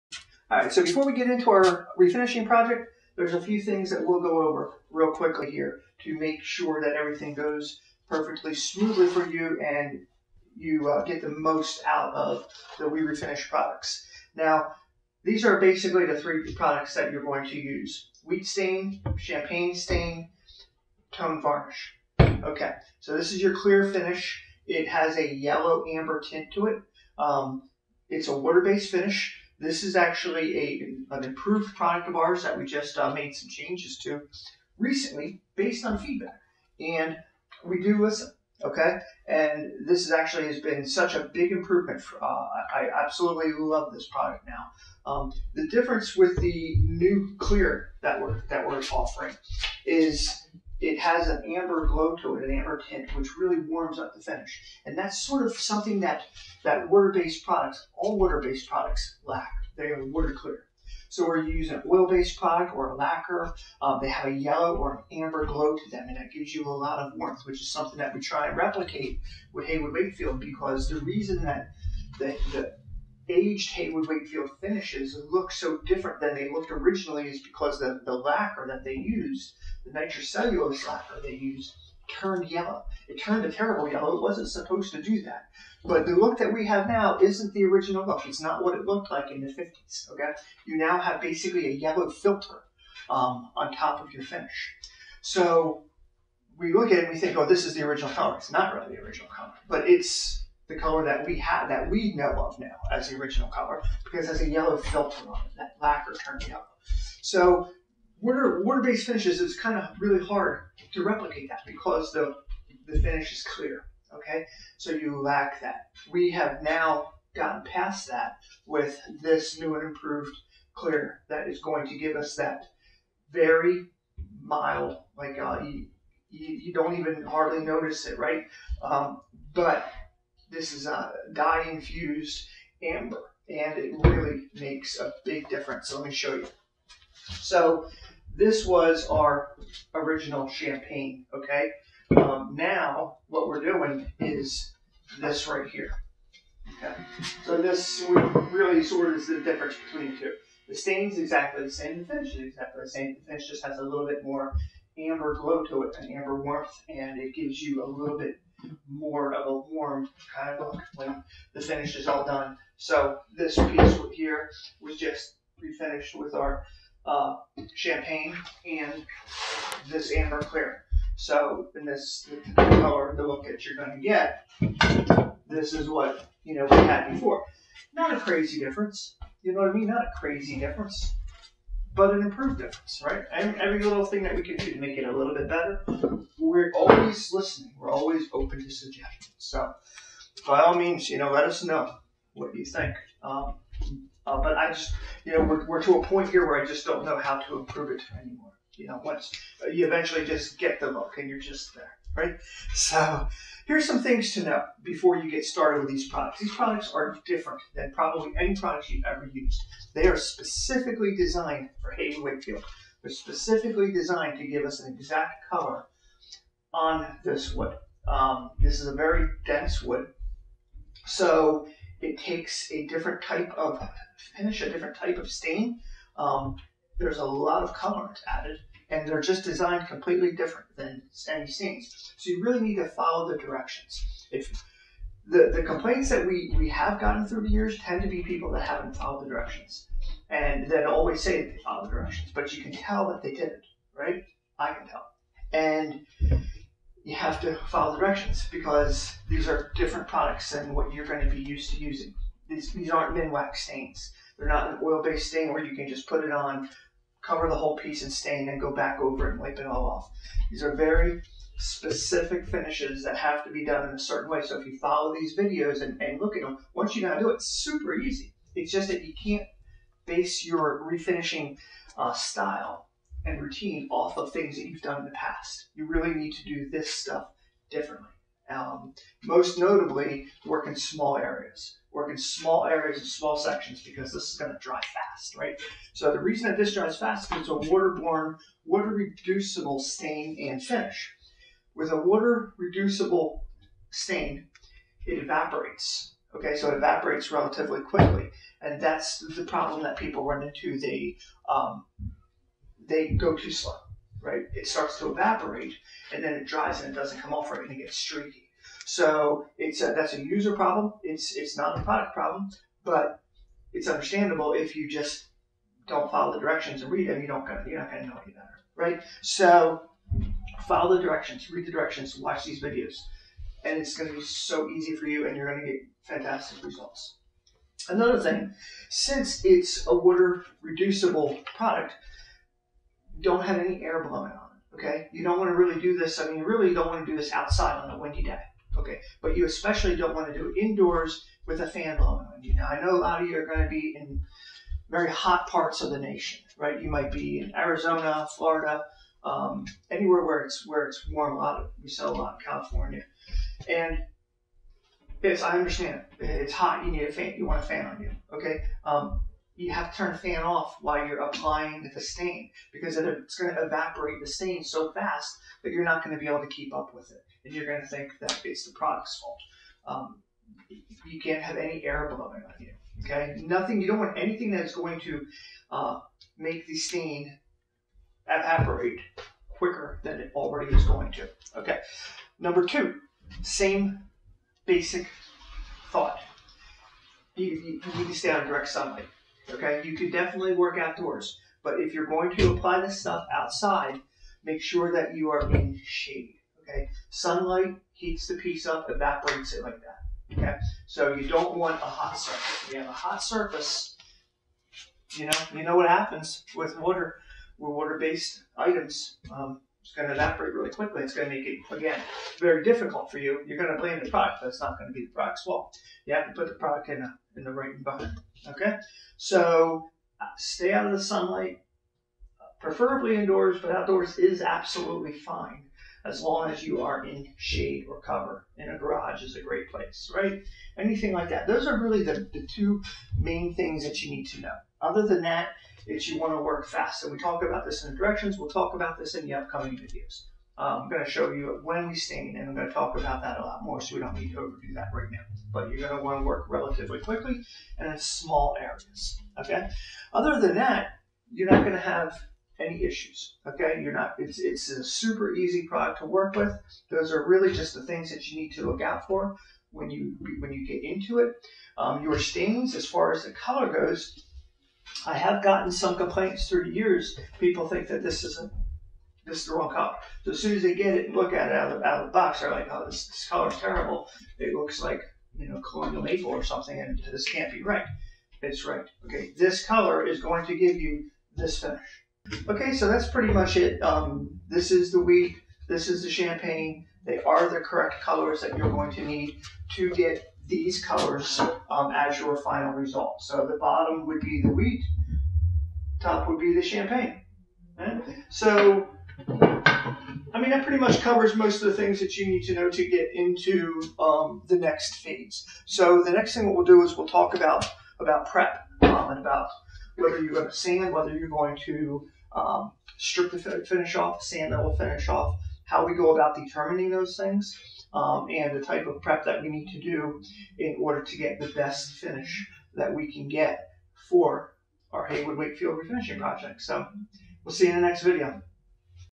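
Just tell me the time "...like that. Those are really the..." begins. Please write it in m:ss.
7:11.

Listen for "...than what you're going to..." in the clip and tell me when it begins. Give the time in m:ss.
4:10.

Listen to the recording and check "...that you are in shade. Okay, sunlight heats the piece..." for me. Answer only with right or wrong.
right.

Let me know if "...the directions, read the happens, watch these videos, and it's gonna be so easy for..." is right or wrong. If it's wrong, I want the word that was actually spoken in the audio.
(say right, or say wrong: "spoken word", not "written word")
wrong: "directions", not "happens".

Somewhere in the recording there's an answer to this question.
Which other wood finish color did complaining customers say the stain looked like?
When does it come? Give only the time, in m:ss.
7:55.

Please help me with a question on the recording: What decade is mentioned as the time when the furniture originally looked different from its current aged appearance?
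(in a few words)
the 50s.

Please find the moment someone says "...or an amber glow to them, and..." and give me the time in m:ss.
1:04.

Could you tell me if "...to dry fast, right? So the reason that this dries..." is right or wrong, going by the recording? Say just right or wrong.
right.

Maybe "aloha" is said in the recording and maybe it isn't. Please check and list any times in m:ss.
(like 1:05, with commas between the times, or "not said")
not said.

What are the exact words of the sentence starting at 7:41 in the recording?
Um, your stains, as far as the color goes, I have gotten some complaints through the years.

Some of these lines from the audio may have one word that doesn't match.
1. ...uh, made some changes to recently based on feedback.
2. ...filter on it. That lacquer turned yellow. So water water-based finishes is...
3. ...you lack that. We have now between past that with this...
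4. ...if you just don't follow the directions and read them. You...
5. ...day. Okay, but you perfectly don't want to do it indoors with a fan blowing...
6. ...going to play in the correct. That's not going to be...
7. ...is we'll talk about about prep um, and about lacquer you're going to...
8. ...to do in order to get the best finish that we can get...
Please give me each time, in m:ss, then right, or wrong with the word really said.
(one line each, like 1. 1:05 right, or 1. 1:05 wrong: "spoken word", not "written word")
1. 0:32 right
2. 1:44 right
3. 1:54 wrong: "gotten", not "between"
4. 5:14 right
5. 5:38 wrong: "especially", not "perfectly"
6. 6:53 wrong: "product", not "correct"
7. 8:26 wrong: "whether", not "lacquer"
8. 8:39 right.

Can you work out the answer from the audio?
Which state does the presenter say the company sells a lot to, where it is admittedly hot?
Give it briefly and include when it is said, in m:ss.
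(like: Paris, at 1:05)
California, at 5:52.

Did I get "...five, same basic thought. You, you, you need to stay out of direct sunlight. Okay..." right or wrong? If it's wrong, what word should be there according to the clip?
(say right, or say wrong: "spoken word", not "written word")
wrong: "two", not "five".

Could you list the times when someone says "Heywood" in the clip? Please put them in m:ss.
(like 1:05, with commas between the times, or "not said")
1:09, 1:13, 3:31, 8:45.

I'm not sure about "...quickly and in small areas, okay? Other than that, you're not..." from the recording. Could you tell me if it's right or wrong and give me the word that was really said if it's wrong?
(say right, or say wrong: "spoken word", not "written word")
right.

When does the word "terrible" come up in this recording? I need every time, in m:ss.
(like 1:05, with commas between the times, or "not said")
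1:23, 7:53.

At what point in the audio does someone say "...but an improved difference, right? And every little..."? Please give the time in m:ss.
3:01.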